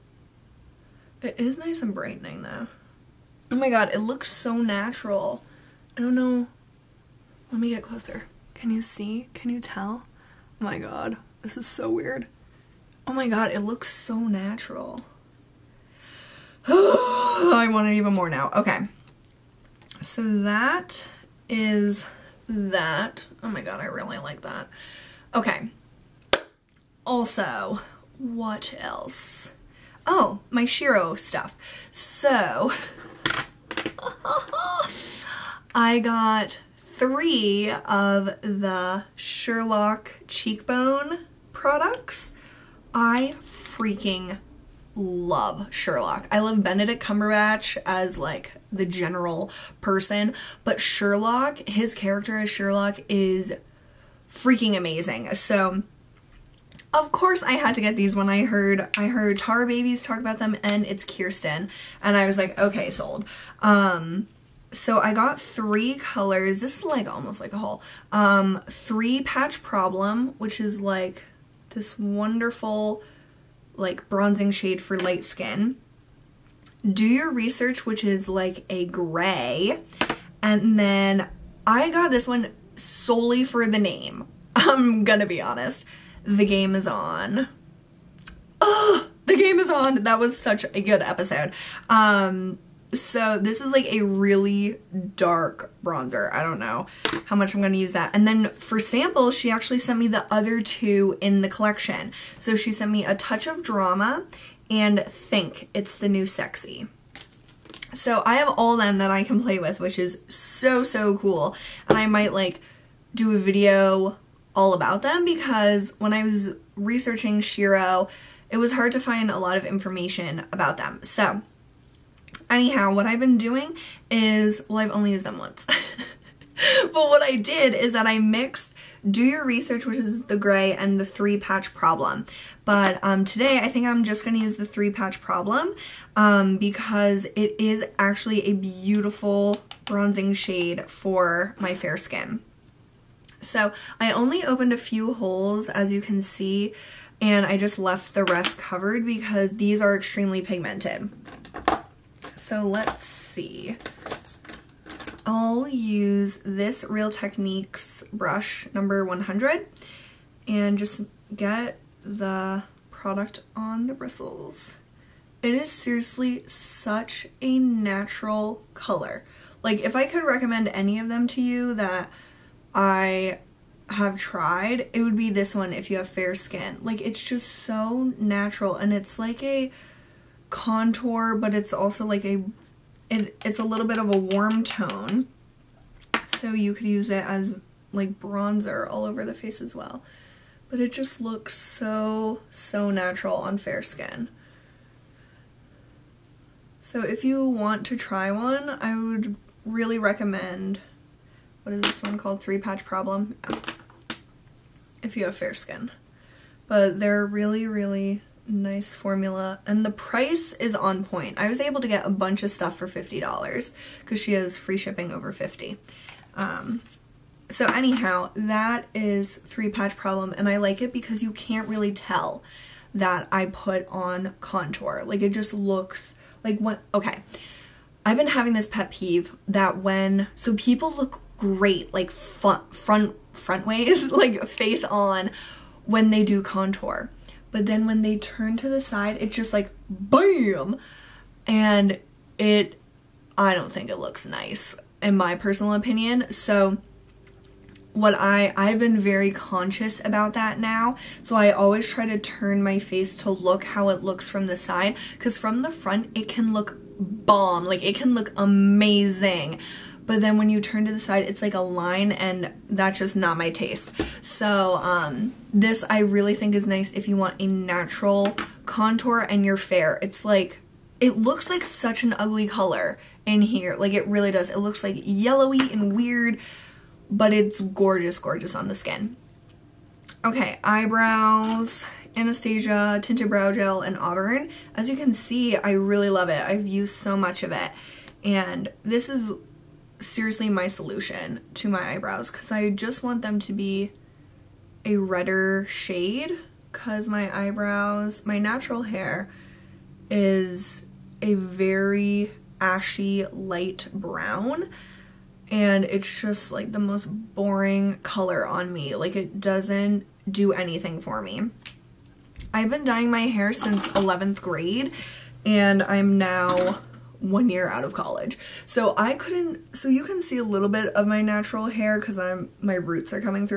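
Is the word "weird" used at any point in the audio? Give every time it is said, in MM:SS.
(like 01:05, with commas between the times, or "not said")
00:11, 04:35.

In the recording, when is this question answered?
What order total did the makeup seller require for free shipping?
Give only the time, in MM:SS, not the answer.
03:34.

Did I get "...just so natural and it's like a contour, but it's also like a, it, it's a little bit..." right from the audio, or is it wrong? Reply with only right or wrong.
right.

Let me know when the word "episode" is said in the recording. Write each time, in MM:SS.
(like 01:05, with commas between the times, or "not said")
01:31.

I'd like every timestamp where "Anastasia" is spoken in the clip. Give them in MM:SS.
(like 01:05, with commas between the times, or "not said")
04:42.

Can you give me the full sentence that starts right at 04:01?
And it, I don't think it looks nice, in my personal opinion.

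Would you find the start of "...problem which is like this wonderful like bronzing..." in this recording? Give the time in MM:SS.
01:09.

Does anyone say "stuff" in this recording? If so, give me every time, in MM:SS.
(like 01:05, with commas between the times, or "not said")
00:31, 03:32.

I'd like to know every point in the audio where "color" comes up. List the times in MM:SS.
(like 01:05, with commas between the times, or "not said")
01:05, 02:48, 04:32, 05:08.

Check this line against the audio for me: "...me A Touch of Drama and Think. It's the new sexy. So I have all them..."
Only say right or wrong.
right.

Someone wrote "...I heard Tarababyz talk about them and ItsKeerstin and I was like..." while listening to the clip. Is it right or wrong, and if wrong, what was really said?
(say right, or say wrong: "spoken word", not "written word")
right.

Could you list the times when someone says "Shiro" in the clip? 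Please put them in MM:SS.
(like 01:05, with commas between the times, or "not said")
00:30, 01:57.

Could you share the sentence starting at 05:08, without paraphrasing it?
Like it doesn't do anything for me.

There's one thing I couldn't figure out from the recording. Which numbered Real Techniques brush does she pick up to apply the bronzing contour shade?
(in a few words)
100.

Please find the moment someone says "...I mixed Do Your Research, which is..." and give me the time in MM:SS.
02:08.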